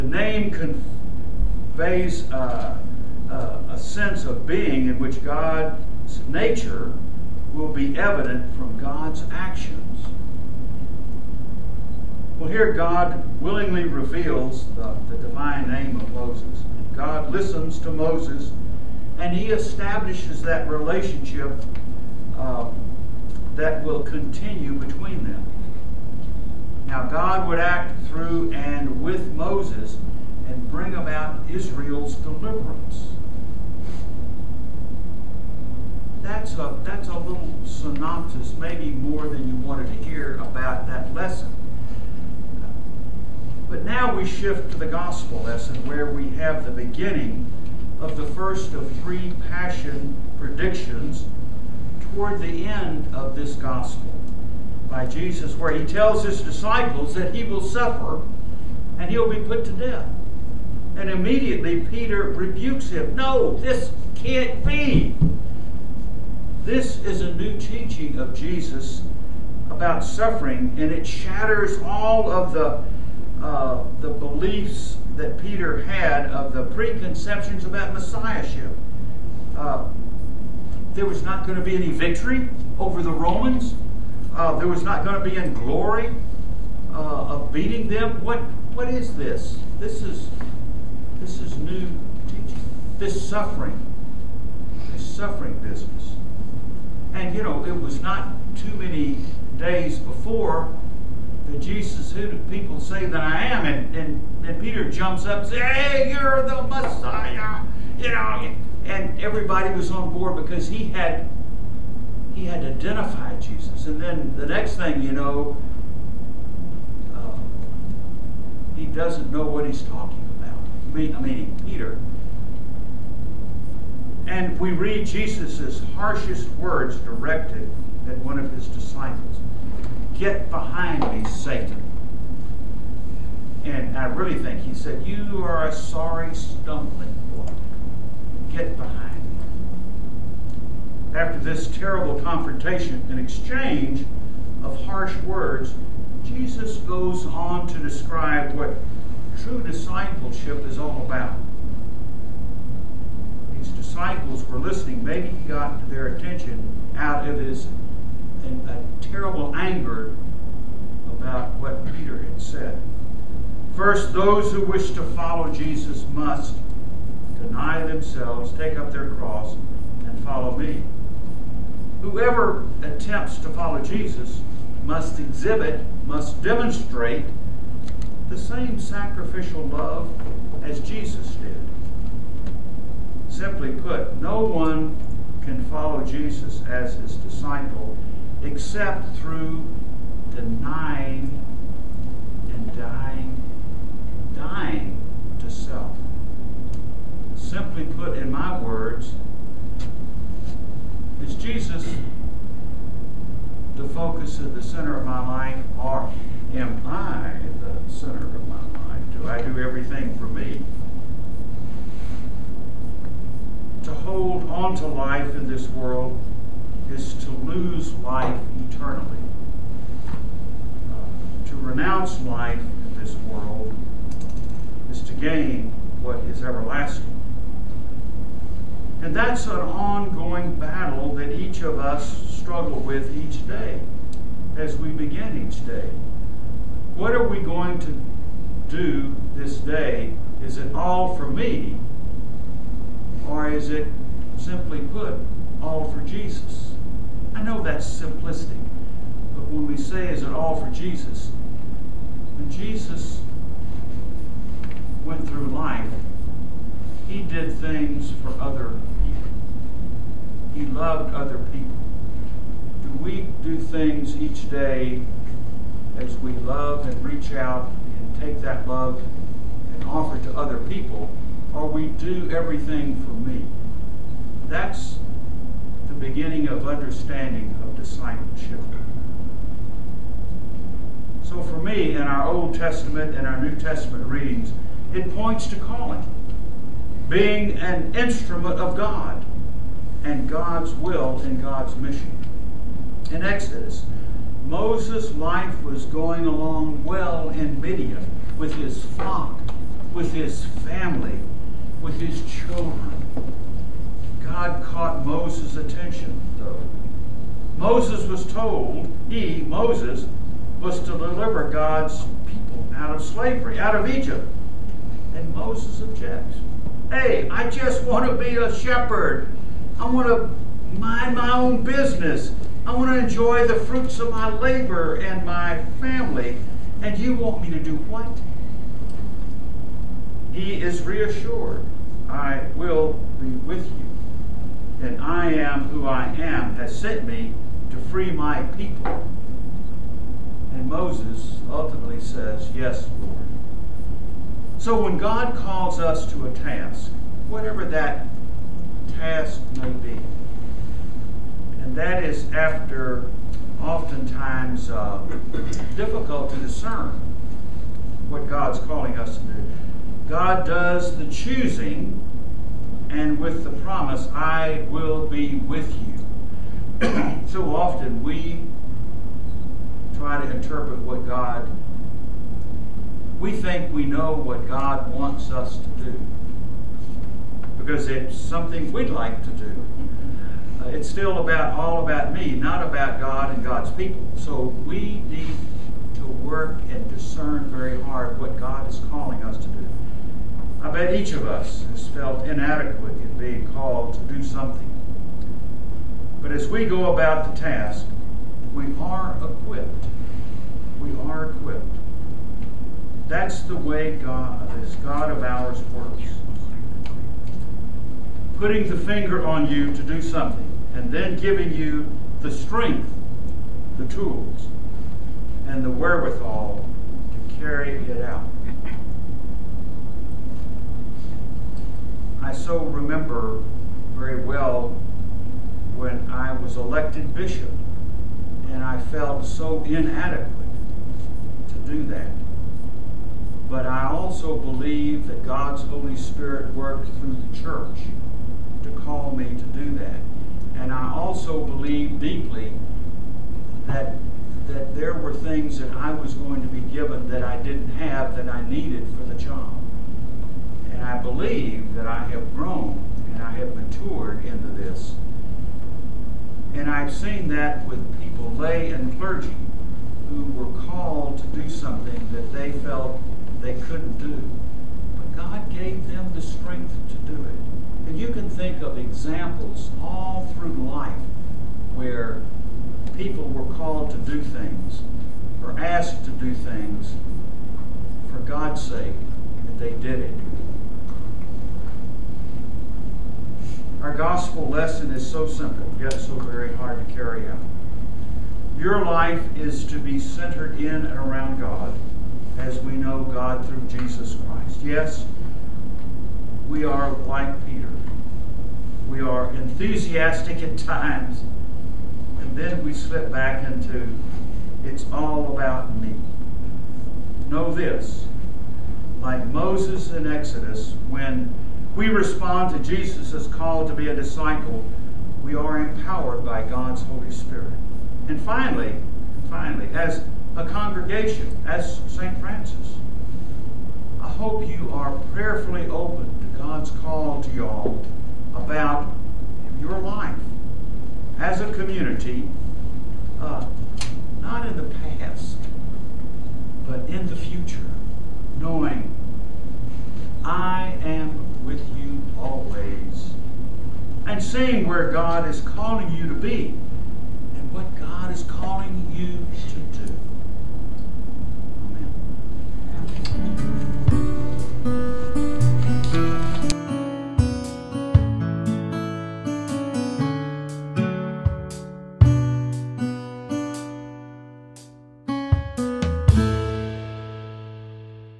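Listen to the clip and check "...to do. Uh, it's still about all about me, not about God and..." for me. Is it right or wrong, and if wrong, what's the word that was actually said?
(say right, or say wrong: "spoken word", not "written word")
right.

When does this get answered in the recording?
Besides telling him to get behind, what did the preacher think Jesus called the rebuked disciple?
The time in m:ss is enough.
2:15.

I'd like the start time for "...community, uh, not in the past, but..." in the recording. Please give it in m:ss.
8:51.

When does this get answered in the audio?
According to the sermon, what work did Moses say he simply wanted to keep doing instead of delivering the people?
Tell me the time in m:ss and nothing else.
5:18.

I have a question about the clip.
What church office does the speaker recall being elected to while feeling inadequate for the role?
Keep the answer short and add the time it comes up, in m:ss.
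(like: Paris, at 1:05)
Bishop, at 7:07.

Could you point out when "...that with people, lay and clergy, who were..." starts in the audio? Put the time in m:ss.
7:37.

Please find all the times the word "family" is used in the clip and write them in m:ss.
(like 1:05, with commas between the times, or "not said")
5:00, 5:25.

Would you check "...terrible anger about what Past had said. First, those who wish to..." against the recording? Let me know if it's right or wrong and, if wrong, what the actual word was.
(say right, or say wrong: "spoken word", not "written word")
wrong: "Peter", not "Past".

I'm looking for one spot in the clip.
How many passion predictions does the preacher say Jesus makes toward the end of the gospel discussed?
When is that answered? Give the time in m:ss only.
0:49.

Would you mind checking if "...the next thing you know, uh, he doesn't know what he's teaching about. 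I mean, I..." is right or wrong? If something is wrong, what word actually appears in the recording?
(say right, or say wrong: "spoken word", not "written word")
wrong: "talking", not "teaching".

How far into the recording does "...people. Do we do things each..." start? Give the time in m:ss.
4:21.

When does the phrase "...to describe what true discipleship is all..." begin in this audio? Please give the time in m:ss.
2:27.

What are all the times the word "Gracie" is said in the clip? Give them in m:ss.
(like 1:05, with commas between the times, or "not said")
not said.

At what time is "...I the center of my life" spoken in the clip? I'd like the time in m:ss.
3:26.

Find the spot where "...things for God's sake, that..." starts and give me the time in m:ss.
7:56.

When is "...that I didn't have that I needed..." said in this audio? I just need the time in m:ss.
7:27.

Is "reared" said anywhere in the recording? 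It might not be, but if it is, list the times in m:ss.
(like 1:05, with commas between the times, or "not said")
not said.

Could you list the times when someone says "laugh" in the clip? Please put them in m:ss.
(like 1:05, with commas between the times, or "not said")
not said.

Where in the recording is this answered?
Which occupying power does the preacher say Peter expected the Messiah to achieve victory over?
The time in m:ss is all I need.
1:23.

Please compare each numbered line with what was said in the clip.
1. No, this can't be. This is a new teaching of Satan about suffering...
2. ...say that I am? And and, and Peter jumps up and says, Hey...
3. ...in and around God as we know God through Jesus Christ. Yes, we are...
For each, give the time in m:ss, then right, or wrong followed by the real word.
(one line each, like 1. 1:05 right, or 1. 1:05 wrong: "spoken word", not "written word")
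1. 1:03 wrong: "Jesus", not "Satan"
2. 1:42 right
3. 8:10 right.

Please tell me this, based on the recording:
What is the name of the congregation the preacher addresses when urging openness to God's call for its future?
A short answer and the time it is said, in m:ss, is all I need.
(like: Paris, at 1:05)
St. Francis, at 8:41.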